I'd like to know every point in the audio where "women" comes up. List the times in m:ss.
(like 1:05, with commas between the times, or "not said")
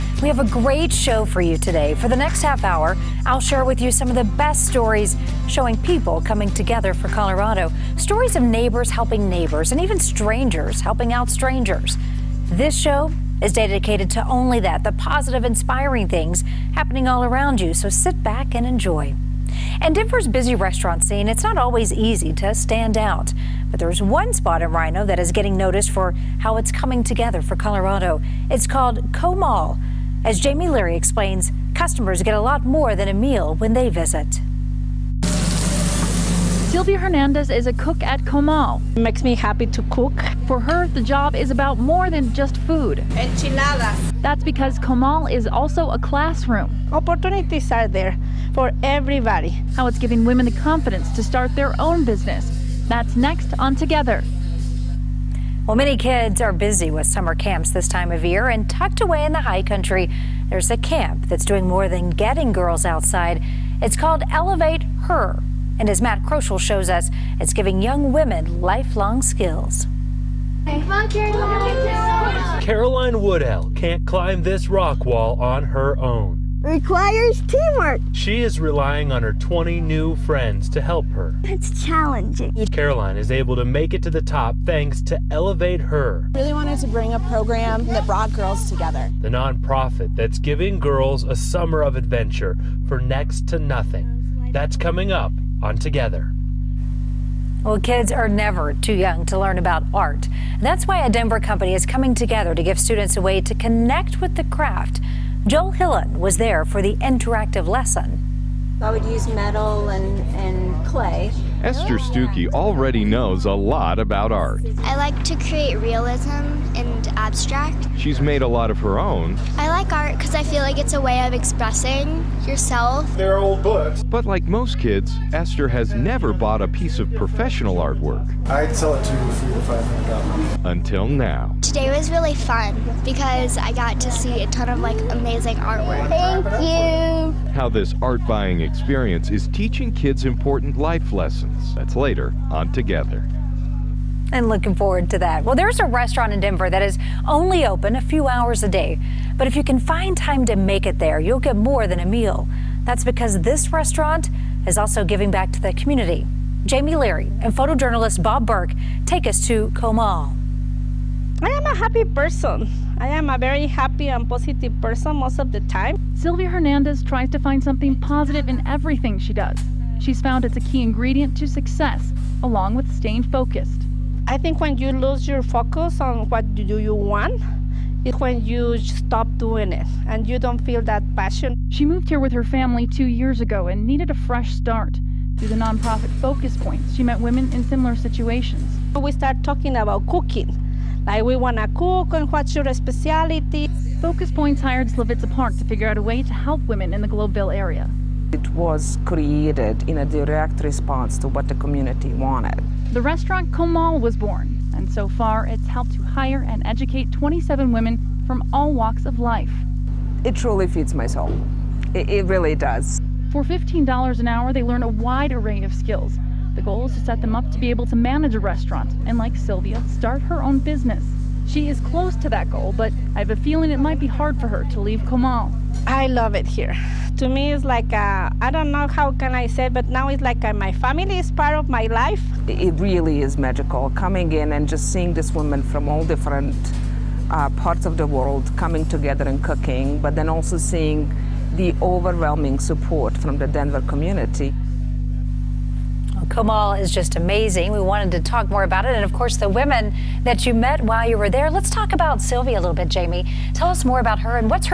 0:50, 1:08, 3:07, 3:16, 3:27, 4:09.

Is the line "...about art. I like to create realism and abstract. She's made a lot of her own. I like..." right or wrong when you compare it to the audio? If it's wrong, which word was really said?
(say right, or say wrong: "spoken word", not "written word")
right.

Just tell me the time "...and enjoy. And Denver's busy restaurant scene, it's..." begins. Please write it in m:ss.
0:18.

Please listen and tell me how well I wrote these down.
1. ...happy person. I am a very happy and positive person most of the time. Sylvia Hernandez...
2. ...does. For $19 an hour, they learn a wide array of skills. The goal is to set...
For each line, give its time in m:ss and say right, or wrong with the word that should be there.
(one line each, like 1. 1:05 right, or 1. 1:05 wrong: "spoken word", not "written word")
1. 2:41 right
2. 3:32 wrong: "15", not "19".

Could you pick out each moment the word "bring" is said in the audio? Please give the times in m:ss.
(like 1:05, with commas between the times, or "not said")
1:26.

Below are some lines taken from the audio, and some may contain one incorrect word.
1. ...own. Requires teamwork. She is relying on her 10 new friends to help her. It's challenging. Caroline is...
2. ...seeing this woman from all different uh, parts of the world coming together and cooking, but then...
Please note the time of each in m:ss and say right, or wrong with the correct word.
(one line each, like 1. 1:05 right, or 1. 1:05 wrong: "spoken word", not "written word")
1. 1:15 wrong: "20", not "10"
2. 3:54 right.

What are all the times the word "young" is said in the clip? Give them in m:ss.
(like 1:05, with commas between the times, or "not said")
1:07, 1:38.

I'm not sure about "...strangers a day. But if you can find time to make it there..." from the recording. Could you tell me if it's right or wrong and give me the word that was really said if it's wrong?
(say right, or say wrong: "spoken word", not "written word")
wrong: "hours", not "strangers".